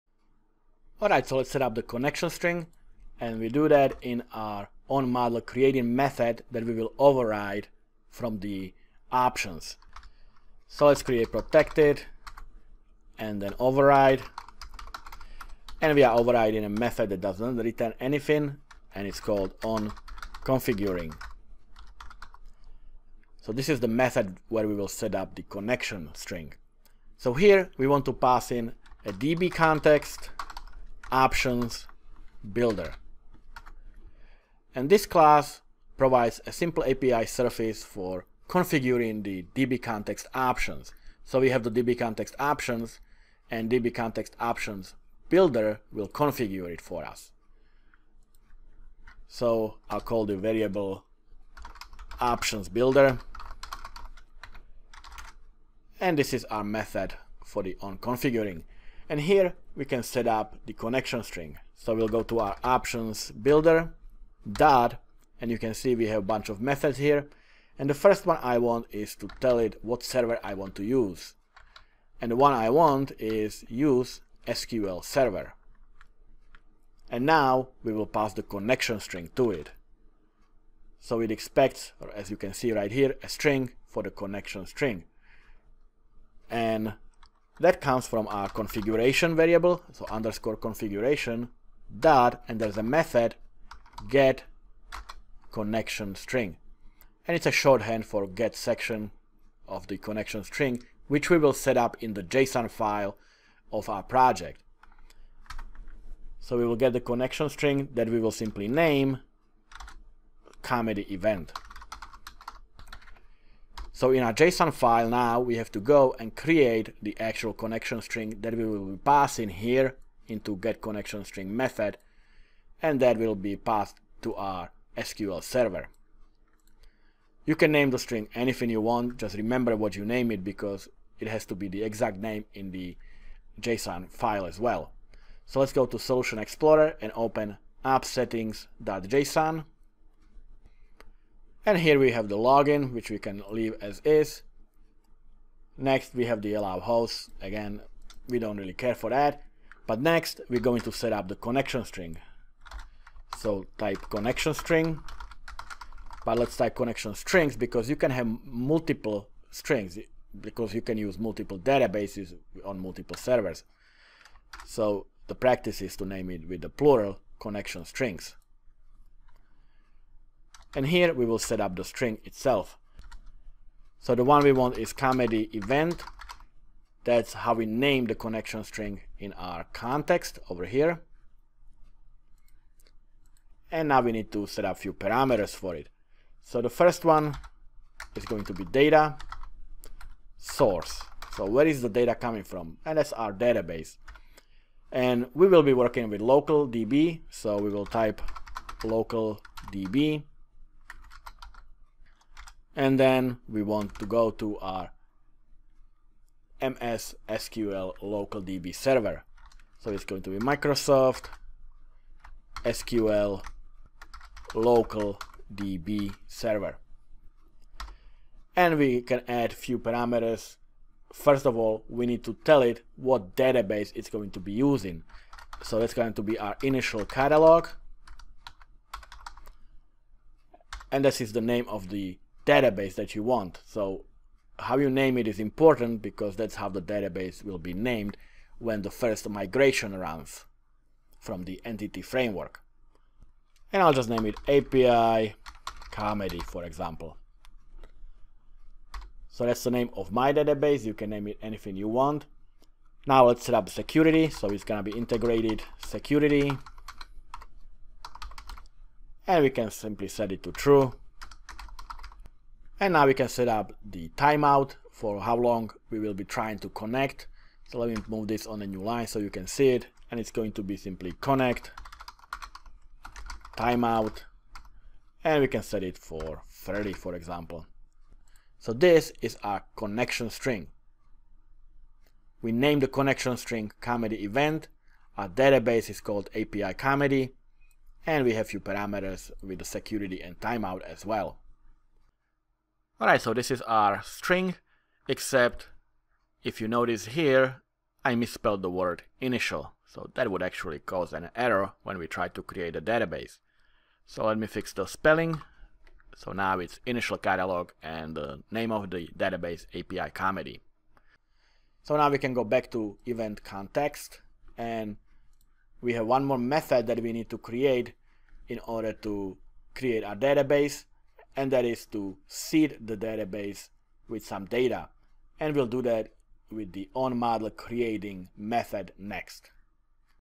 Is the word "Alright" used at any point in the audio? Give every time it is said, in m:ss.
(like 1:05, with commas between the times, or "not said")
0:01, 4:53.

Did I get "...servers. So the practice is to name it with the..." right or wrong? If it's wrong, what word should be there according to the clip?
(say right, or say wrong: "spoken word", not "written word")
right.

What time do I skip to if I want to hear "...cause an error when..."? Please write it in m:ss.
5:00.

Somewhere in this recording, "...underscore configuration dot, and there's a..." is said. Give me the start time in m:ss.
1:30.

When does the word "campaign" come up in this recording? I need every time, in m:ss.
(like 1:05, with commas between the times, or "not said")
not said.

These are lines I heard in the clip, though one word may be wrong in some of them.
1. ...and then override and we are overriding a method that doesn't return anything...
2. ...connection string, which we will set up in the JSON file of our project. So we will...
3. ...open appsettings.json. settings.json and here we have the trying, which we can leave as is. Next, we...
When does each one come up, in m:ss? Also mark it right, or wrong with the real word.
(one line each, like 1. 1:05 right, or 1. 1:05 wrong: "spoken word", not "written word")
1. 0:13 right
2. 1:39 right
3. 2:17 wrong: "logging", not "trying".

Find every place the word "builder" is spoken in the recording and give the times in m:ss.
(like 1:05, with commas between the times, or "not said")
0:32, 0:45, 0:52, 1:03.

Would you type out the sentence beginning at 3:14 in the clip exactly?
And we will be working with local DB.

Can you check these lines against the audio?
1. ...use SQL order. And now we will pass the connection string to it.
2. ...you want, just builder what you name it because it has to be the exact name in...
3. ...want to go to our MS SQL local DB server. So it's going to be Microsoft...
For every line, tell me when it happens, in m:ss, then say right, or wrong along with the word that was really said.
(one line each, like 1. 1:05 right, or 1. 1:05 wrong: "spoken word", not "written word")
1. 1:13 wrong: "server", not "order"
2. 2:08 wrong: "remember", not "builder"
3. 3:23 right.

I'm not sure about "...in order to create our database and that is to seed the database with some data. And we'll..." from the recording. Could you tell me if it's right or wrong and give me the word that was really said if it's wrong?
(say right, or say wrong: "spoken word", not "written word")
right.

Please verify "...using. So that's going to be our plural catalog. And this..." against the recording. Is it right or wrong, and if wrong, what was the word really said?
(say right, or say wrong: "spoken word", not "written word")
wrong: "initial", not "plural".